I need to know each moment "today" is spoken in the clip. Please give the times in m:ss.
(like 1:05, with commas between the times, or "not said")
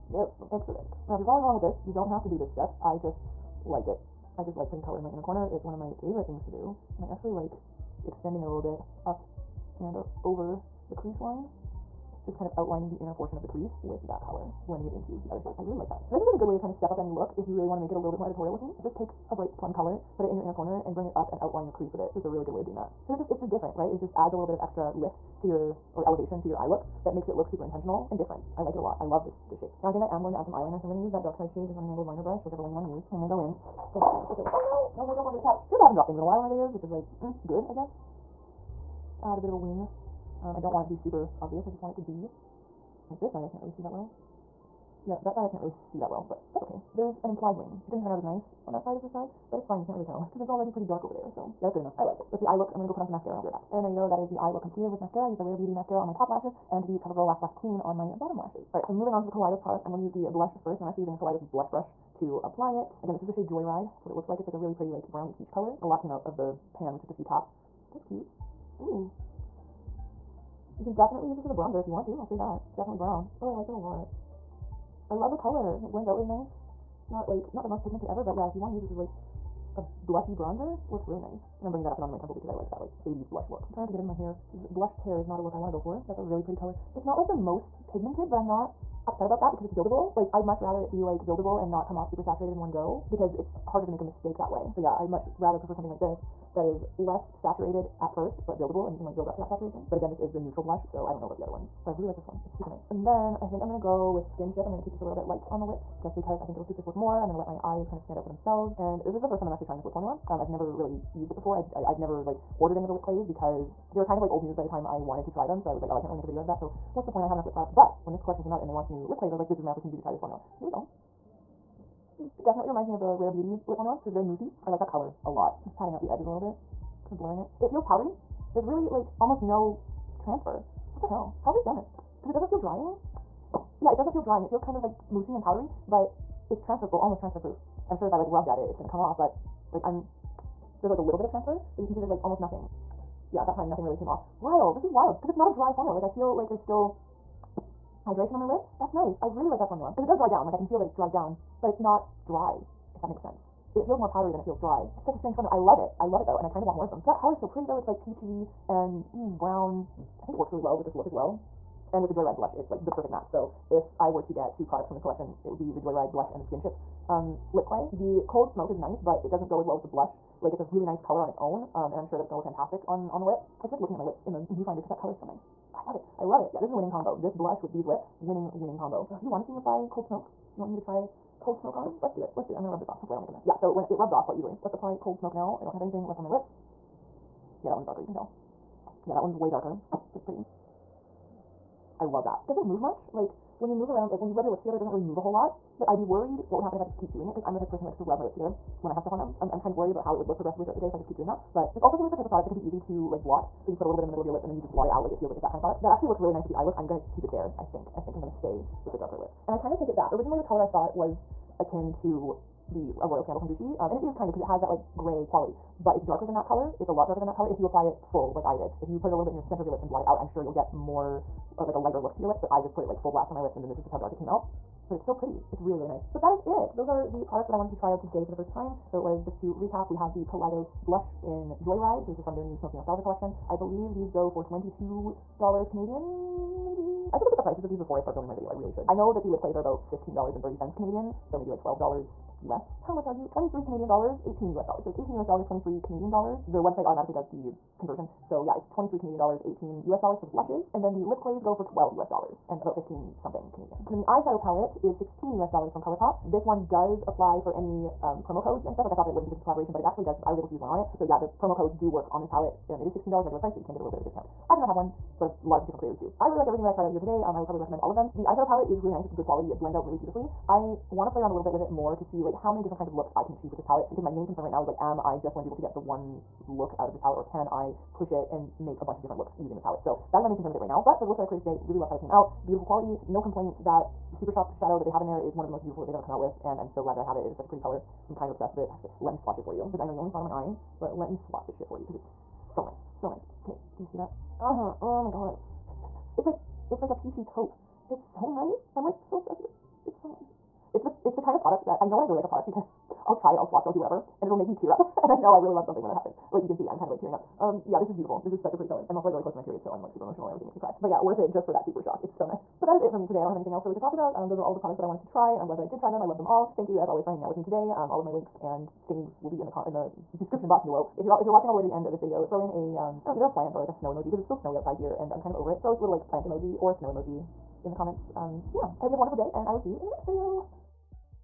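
3:47, 4:26, 4:41, 5:13, 5:17.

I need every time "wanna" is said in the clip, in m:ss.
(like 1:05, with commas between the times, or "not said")
0:32, 1:25.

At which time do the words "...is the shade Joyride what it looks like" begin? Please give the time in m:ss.
1:03.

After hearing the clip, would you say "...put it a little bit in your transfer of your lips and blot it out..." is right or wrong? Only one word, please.
wrong.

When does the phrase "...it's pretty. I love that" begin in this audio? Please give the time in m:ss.
3:10.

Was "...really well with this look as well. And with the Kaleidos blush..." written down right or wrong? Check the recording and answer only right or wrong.
wrong.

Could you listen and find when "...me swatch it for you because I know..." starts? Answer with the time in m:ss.
4:49.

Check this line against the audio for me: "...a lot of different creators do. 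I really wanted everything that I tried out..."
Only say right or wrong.
wrong.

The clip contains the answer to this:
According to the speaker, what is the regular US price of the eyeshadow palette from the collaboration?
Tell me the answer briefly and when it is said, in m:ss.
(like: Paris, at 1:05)
$16, at 4:14.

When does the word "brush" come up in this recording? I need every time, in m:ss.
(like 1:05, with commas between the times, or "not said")
0:32, 1:01.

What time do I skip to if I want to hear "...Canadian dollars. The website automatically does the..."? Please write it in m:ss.
4:05.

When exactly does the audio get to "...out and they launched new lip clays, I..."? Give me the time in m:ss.
1:58.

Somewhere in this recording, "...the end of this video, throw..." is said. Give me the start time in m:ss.
5:21.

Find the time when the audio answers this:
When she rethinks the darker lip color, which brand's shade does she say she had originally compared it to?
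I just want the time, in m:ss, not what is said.
3:33.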